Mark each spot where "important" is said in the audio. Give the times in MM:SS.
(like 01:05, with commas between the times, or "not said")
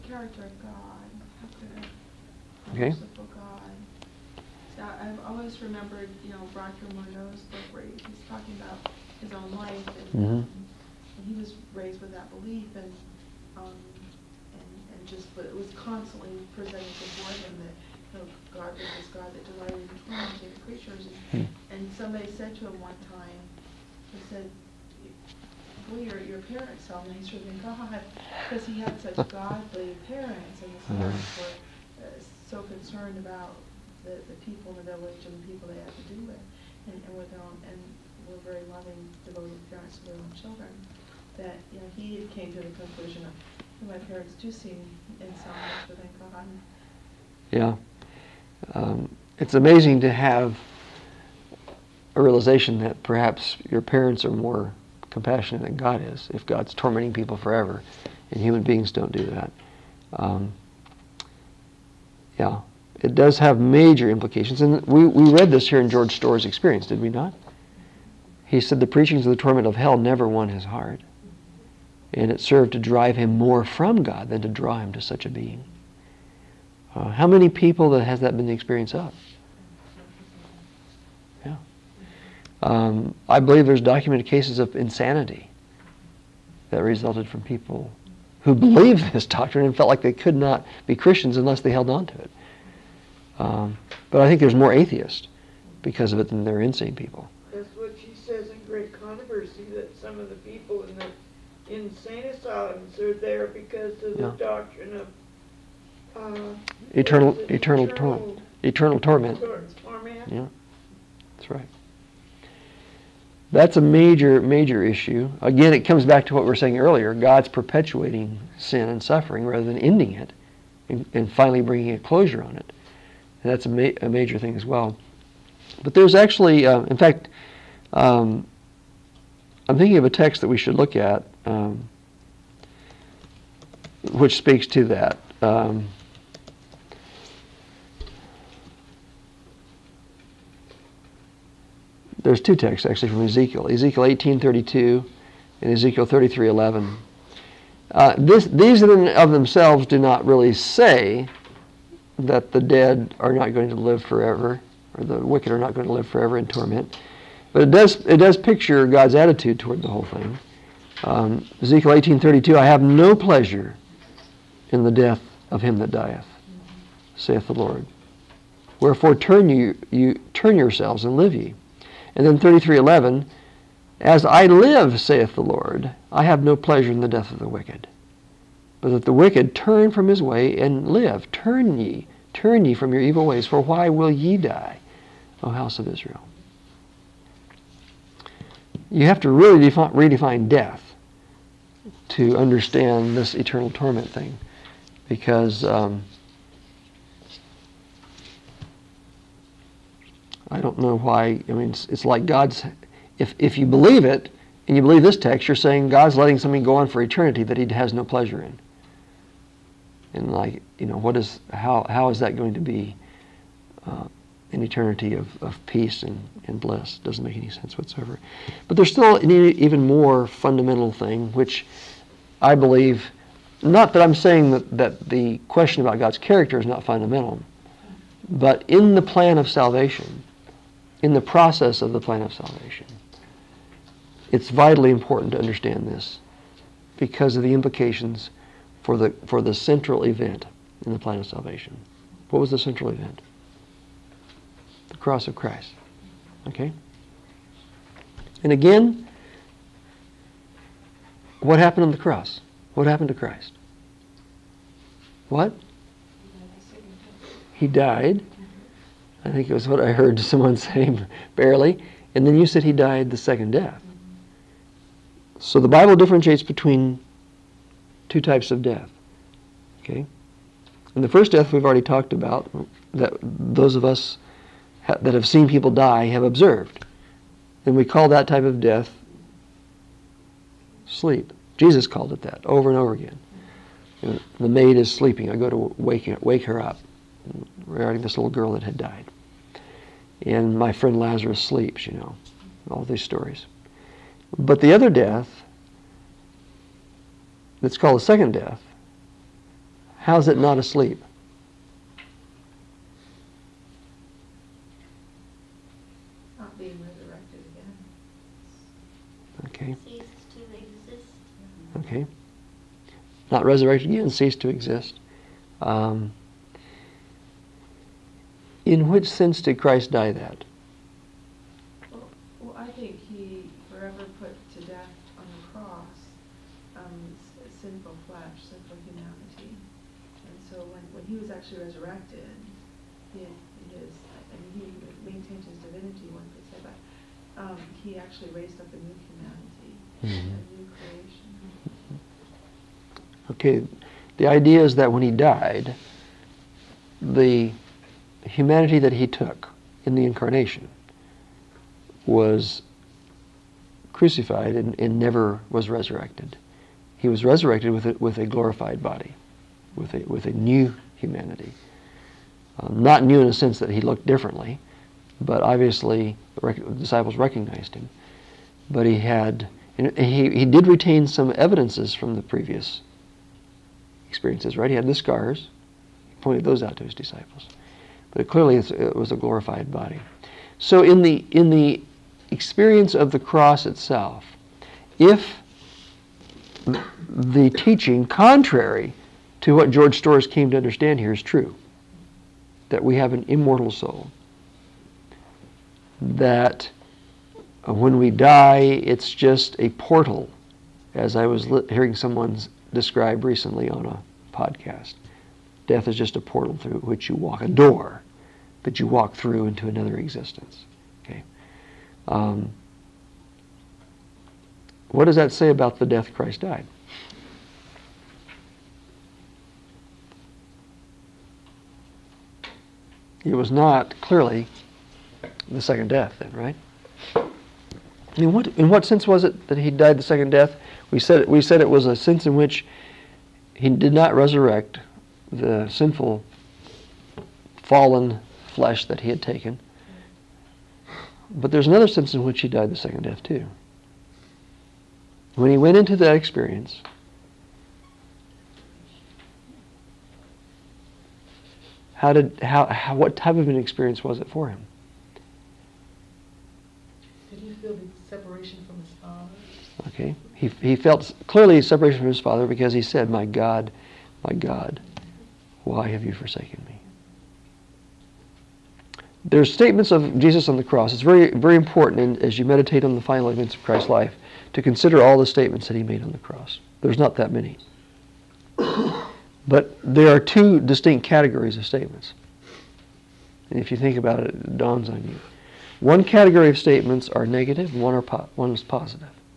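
03:54, 07:51.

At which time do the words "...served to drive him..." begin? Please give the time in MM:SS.
01:12.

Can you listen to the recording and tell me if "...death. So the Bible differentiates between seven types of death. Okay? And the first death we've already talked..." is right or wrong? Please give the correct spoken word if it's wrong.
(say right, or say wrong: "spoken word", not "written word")
wrong: "two", not "seven".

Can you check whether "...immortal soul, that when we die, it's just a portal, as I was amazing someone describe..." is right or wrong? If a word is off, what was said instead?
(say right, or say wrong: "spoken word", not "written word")
wrong: "hearing", not "amazing".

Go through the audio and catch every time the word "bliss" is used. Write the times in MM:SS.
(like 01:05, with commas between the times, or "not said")
03:36.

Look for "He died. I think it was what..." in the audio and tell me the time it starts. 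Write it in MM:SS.
04:17.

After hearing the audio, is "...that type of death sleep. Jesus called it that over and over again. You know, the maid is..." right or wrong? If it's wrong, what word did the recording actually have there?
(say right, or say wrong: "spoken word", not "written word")
right.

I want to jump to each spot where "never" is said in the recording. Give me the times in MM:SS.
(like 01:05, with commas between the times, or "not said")
01:09, 05:54.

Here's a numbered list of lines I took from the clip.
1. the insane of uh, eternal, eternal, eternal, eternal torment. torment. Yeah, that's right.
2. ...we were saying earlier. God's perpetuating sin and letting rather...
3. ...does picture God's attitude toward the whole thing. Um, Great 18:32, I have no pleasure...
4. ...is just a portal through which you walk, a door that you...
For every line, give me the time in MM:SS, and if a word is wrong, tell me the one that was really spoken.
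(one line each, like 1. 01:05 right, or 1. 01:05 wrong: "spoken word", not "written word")
1. 01:44 wrong: "doctrine", not "insane"
2. 01:56 wrong: "suffering", not "letting"
3. 02:38 wrong: "Ezekiel", not "Great"
4. 06:45 right.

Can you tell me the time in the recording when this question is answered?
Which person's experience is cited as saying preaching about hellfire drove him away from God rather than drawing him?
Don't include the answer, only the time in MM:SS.
01:05.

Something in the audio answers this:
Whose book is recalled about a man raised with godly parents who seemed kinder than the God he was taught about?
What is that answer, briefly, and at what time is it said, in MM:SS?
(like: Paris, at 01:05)
Roger Morneau, at 00:06.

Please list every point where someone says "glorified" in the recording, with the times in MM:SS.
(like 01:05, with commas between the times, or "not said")
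05:58, 06:19.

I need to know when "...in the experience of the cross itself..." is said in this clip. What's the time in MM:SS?
06:21.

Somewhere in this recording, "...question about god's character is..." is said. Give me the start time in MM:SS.
03:45.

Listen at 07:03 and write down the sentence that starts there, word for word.
It was not clearly the second death, then, right?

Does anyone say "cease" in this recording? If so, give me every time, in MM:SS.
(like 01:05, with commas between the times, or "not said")
05:09, 05:14.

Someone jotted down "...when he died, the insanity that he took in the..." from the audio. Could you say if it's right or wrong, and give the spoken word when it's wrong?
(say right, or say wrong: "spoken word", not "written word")
wrong: "humanity", not "insanity".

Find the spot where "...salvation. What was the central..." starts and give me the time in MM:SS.
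04:01.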